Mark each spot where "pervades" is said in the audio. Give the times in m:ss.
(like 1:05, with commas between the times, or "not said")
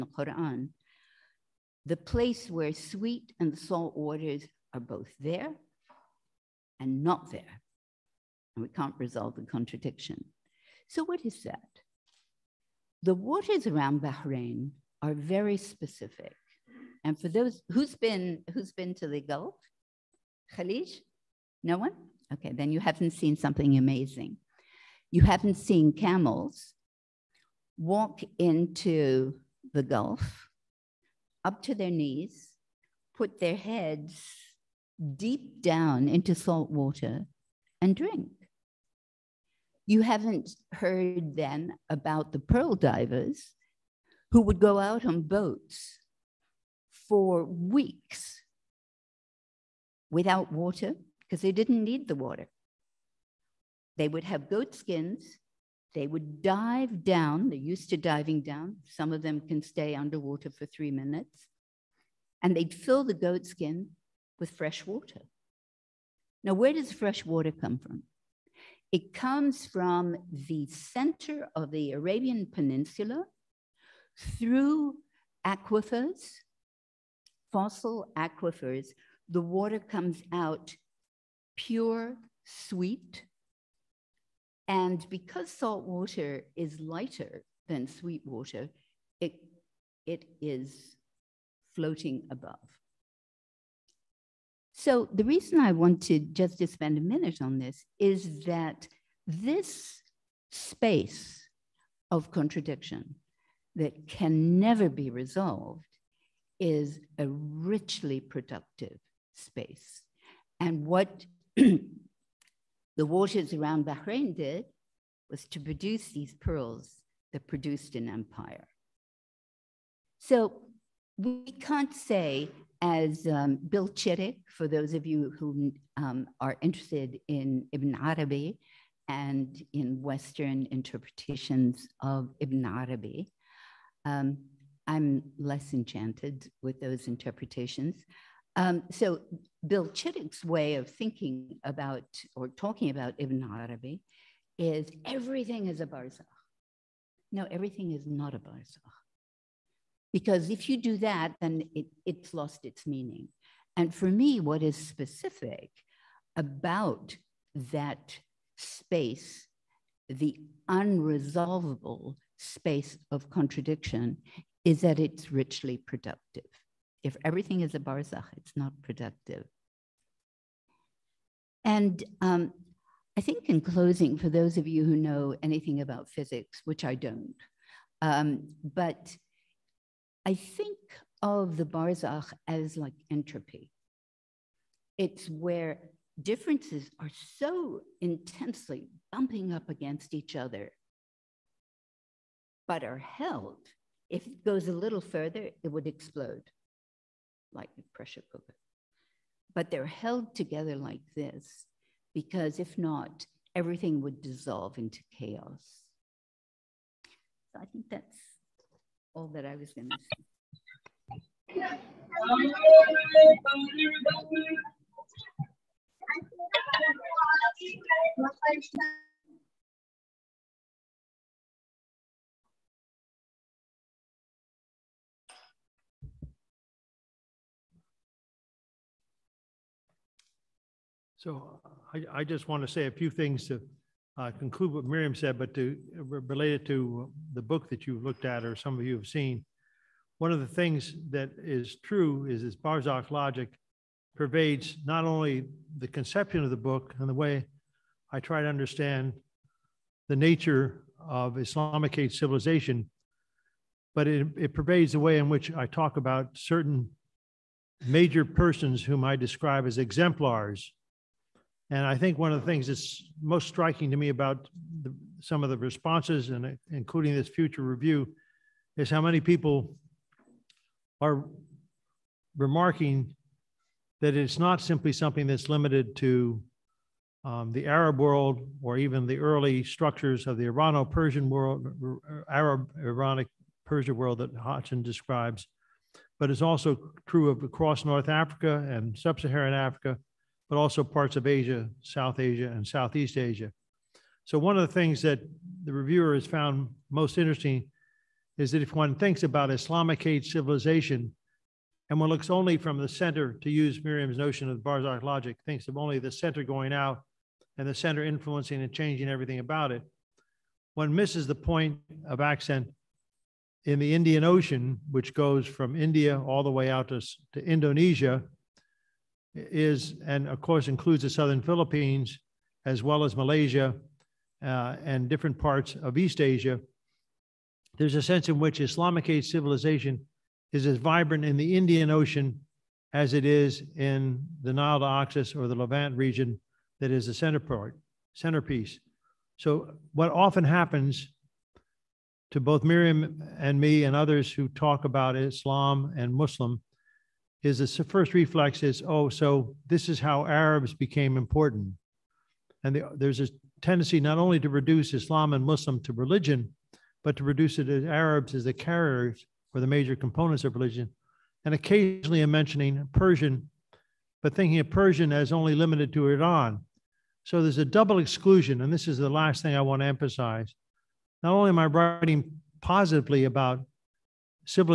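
4:04, 4:14.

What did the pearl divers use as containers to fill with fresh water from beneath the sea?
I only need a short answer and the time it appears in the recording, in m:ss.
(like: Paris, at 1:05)
goat skins, at 0:54.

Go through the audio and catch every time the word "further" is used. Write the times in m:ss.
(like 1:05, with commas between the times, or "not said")
3:15.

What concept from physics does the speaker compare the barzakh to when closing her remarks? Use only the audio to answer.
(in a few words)
entropy.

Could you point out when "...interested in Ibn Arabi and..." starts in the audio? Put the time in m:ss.
2:06.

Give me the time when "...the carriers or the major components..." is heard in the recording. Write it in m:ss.
5:58.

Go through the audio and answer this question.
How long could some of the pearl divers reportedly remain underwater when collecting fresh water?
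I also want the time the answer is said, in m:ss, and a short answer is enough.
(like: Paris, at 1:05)
3 minutes, at 1:00.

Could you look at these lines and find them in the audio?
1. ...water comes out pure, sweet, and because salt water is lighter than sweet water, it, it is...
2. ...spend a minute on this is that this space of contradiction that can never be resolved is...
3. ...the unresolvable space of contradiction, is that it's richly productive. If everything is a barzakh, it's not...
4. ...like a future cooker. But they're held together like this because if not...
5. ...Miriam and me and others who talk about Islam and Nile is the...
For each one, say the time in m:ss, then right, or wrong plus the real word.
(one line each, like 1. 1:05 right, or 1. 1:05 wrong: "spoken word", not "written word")
1. 1:19 right
2. 1:36 right
3. 2:40 right
4. 3:17 wrong: "pressure", not "future"
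5. 5:42 wrong: "Muslim", not "Nile".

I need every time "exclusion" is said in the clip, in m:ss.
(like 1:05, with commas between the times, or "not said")
6:07.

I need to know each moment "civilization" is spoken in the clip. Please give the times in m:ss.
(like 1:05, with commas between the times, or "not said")
4:12, 5:00, 5:29.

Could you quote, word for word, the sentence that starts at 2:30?
Because if you do that, then it, it's lost its meaning.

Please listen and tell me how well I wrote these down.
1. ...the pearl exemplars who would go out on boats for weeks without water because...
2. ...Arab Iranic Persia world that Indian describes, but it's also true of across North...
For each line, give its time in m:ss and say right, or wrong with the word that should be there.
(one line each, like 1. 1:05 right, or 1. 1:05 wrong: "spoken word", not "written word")
1. 0:42 wrong: "divers", not "exemplars"
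2. 4:42 wrong: "Hodgson", not "Indian".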